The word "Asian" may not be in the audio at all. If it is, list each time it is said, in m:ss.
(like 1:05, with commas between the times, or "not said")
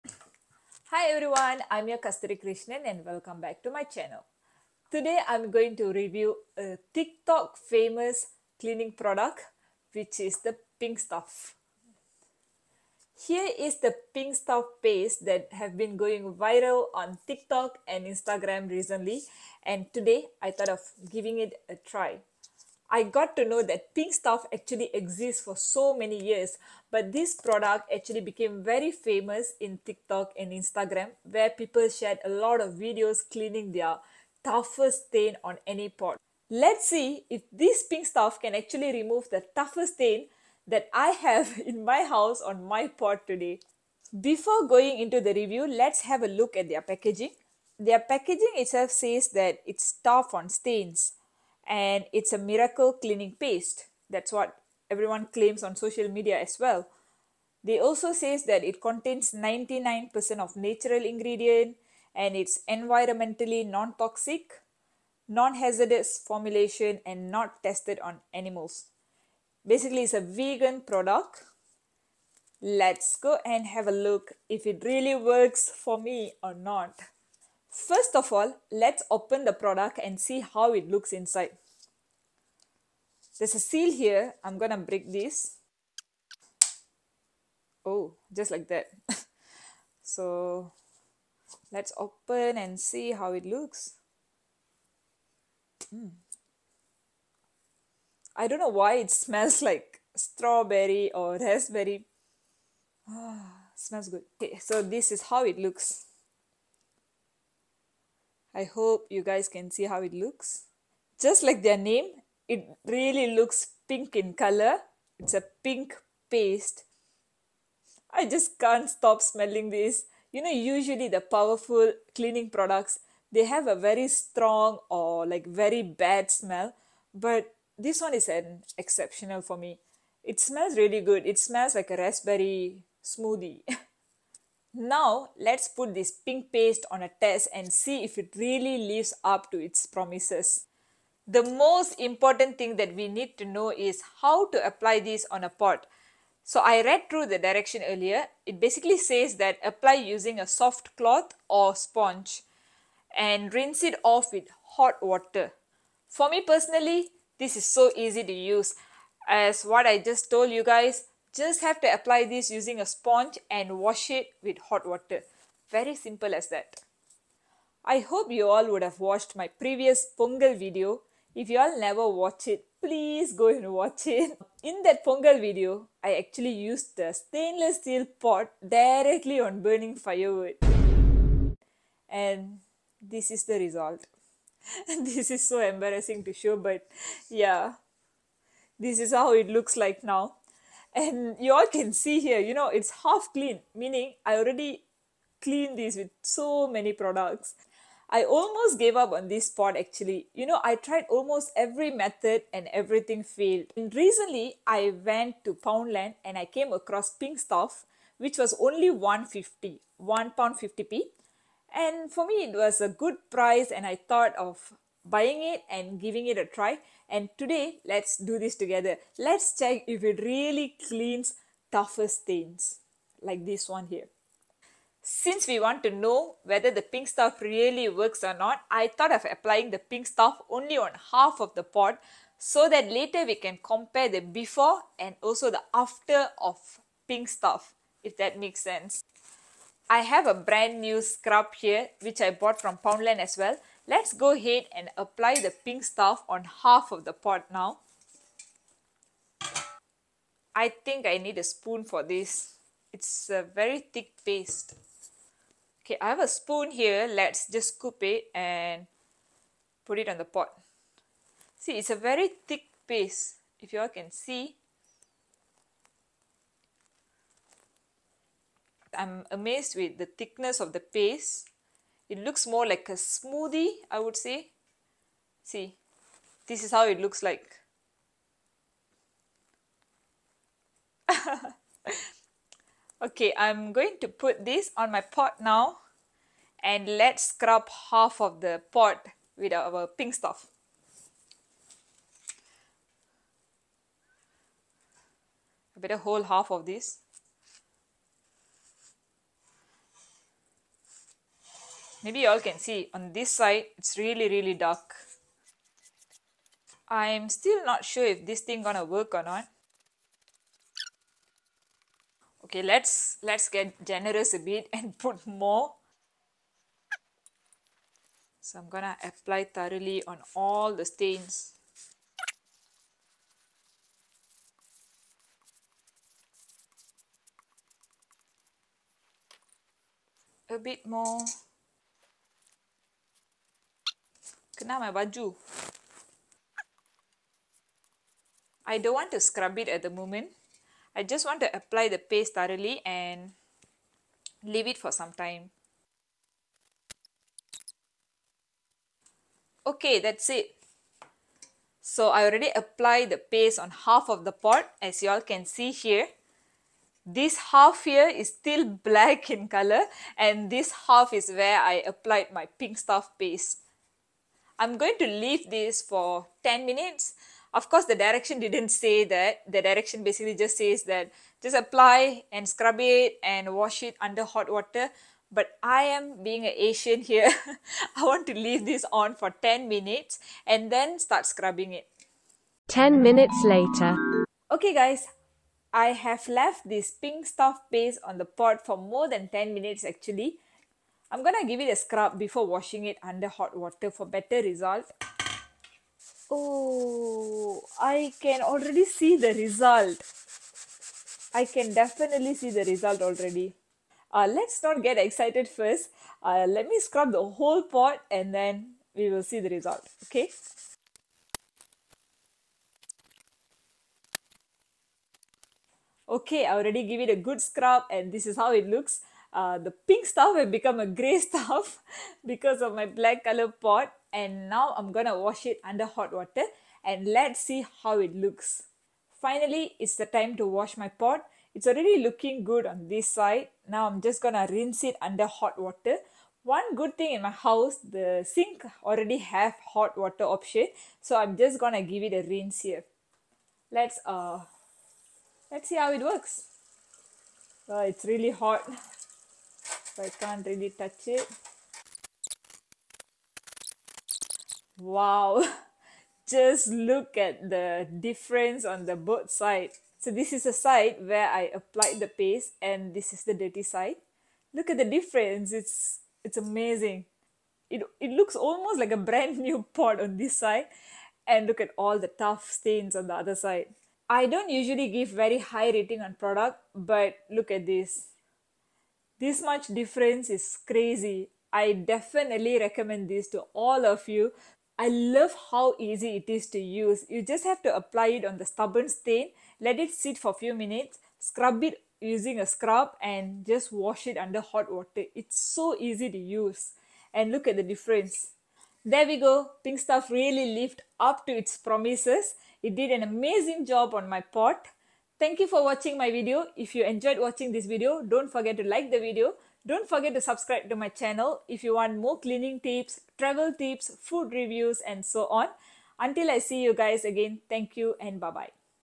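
6:16.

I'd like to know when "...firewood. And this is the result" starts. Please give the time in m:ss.
2:59.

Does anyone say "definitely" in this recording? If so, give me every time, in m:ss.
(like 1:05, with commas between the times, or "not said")
6:41, 8:01.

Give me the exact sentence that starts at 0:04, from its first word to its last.
Today I'm going to review a TikTok famous cleaning product which is the pink stuff.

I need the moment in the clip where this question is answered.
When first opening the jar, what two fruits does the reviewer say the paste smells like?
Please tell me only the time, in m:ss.
1:40.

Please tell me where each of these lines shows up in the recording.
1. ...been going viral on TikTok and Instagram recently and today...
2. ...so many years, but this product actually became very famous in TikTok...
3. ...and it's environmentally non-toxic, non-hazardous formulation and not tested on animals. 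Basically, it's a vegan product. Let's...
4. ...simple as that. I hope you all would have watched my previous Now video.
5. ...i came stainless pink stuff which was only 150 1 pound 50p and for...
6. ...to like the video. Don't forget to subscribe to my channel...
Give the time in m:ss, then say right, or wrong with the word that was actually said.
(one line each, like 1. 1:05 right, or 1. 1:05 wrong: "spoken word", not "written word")
1. 0:15 right
2. 0:25 right
3. 1:02 right
4. 2:45 wrong: "Pongal", not "Now"
5. 3:26 wrong: "across", not "stainless"
6. 8:28 right.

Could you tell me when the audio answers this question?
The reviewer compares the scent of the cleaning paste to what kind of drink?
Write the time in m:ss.
2:11.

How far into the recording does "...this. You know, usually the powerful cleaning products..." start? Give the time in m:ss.
1:59.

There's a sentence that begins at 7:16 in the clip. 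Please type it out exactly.
One good thing in my house, the sink already have hot water option.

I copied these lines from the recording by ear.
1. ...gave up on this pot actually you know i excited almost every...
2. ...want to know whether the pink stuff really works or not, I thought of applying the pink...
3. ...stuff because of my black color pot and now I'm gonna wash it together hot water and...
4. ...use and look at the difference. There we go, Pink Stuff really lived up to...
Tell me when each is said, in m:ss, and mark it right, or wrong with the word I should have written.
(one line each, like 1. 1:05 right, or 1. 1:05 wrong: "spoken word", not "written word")
1. 3:18 wrong: "tried", not "excited"
2. 3:45 right
3. 7:01 wrong: "under", not "together"
4. 8:16 right.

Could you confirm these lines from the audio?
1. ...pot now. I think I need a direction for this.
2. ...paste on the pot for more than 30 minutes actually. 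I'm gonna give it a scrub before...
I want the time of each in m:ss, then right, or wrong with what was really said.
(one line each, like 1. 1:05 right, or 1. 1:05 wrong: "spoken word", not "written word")
1. 4:07 wrong: "spoon", not "direction"
2. 6:27 wrong: "10", not "30".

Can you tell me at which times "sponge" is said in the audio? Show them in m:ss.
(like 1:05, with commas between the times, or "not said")
2:31, 2:42.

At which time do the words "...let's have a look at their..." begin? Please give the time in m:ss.
0:45.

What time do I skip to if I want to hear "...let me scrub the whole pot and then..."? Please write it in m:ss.
6:46.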